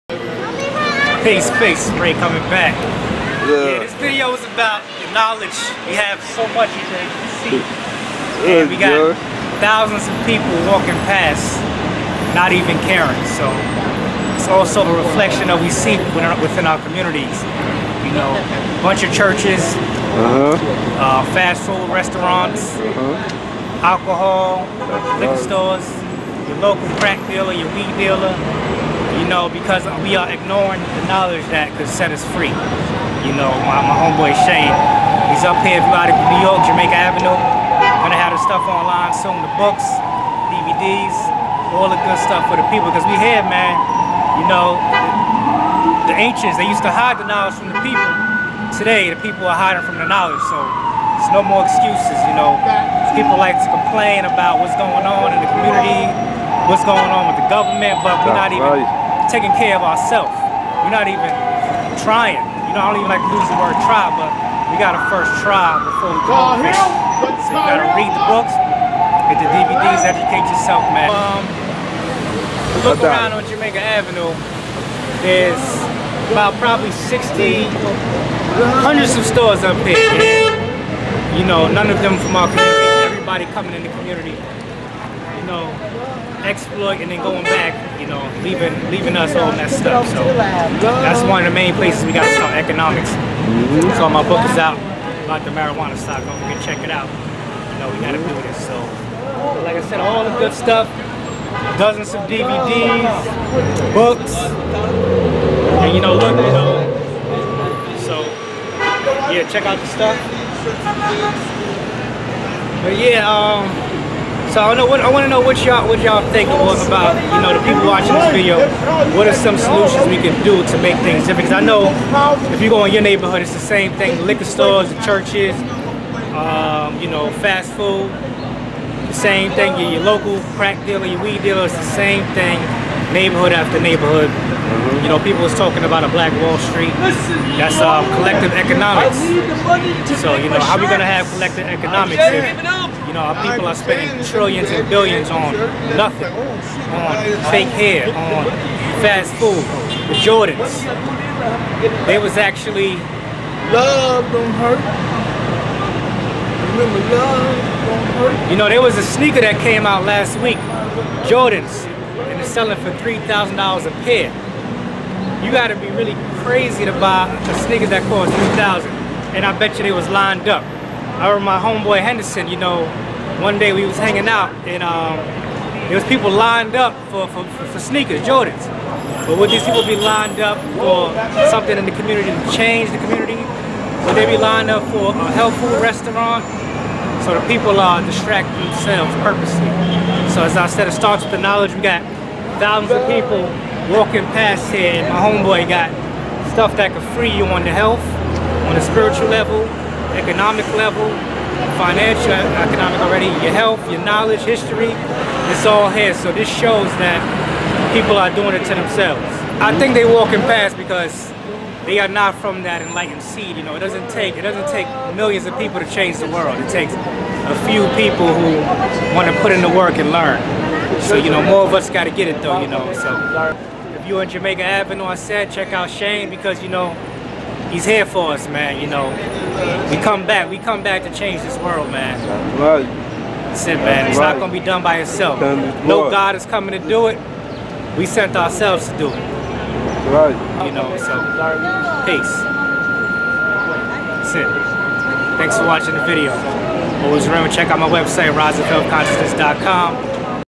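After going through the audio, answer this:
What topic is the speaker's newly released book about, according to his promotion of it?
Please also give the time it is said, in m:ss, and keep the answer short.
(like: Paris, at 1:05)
Marijuana stock, at 1:35.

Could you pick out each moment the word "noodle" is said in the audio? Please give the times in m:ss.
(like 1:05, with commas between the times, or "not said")
not said.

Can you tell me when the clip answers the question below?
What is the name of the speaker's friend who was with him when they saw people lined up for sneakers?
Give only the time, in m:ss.
2:52.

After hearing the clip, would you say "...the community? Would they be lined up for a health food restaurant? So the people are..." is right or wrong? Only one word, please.
right.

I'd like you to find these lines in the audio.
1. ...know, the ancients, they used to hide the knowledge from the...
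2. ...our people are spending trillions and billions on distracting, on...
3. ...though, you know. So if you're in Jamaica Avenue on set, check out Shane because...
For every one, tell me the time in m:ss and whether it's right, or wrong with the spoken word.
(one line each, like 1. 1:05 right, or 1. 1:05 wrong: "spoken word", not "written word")
1. 0:44 right
2. 2:23 wrong: "nothing", not "distracting"
3. 3:42 right.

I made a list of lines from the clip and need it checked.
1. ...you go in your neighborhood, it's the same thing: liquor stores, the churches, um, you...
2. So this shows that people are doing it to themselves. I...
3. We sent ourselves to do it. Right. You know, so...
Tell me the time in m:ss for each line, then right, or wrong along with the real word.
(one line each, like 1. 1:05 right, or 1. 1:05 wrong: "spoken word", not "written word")
1. 2:02 right
2. 3:26 right
3. 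3:57 right.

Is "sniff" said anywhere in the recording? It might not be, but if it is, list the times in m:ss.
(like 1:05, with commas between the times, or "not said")
not said.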